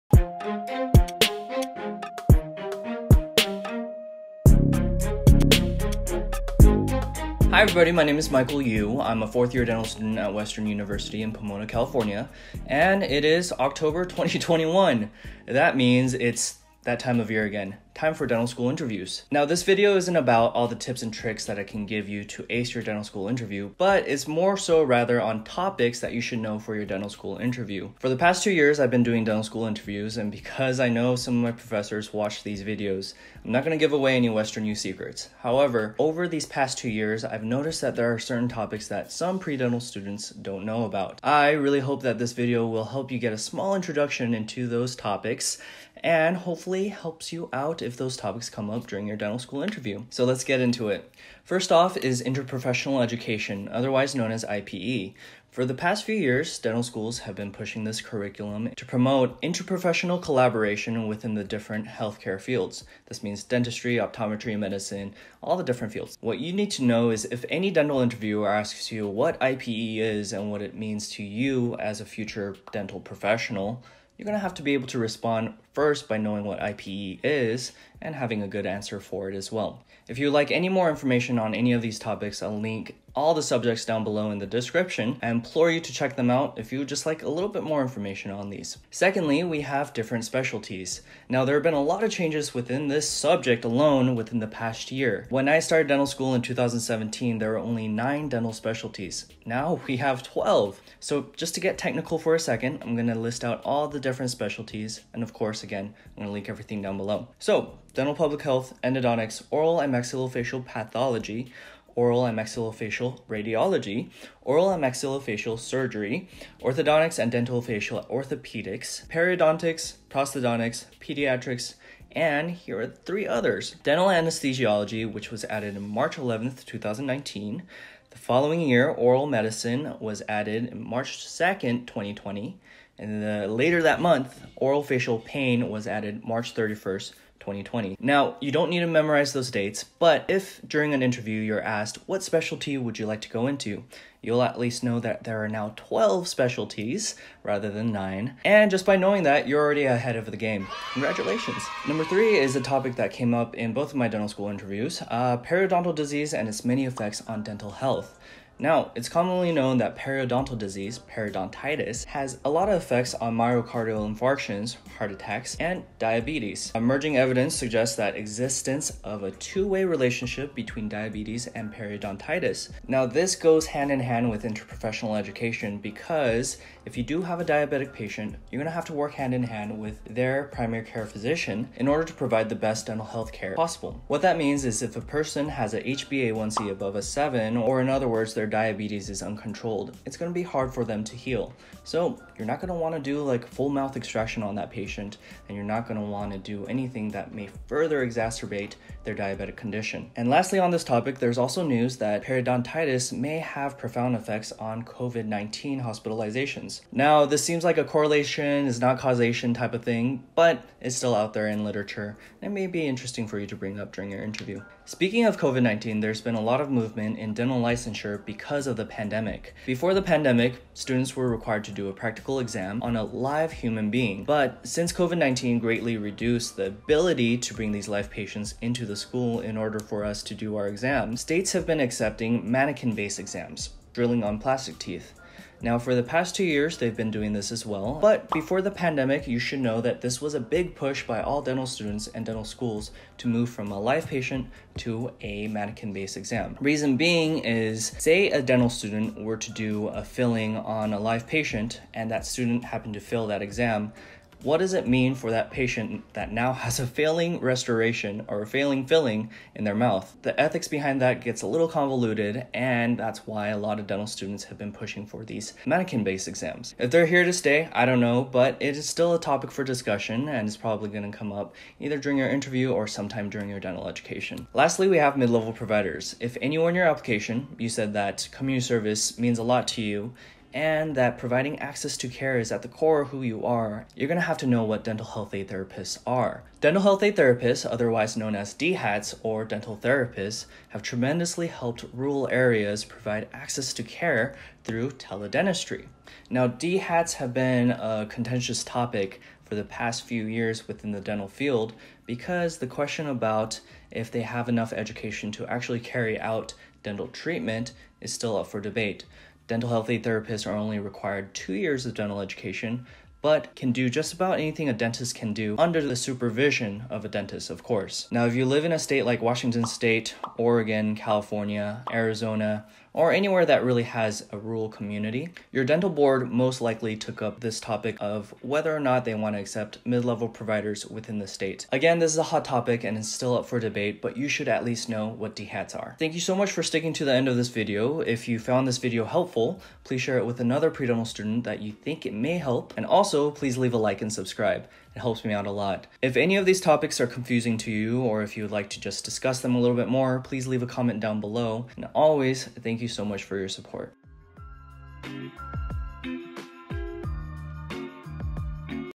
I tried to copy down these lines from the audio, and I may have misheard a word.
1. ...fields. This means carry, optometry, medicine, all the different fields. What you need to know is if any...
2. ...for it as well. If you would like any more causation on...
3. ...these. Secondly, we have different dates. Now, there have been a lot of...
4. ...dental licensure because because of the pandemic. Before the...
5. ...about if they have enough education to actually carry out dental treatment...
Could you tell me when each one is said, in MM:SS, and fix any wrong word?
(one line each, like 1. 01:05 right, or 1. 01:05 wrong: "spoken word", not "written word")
1. 01:02 wrong: "dentistry", not "carry"
2. 01:18 wrong: "information", not "causation"
3. 01:28 wrong: "specialties", not "dates"
4. 03:37 right
5. 05:03 right.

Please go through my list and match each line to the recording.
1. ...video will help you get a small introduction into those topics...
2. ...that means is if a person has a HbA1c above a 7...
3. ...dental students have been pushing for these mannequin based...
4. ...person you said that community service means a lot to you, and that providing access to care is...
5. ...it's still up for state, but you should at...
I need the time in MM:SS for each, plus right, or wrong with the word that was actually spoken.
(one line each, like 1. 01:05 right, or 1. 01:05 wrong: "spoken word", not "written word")
1. 00:42 right
2. 03:04 right
3. 04:23 right
4. 04:36 wrong: "application", not "person"
5. 05:32 wrong: "debate", not "state".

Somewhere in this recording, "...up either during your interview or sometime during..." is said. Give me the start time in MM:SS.
04:31.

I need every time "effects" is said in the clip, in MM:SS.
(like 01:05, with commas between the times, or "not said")
02:36, 02:42, 03:24.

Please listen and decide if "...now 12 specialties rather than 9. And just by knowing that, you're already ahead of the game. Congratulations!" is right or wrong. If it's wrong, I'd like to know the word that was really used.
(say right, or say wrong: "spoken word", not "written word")
right.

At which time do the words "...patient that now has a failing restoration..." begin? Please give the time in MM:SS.
04:15.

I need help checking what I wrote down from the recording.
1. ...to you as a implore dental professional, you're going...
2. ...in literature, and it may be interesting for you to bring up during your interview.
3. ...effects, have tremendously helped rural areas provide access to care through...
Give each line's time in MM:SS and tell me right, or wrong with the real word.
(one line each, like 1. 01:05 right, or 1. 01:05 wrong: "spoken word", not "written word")
1. 01:11 wrong: "future", not "implore"
2. 03:31 right
3. 04:49 wrong: "therapists", not "effects".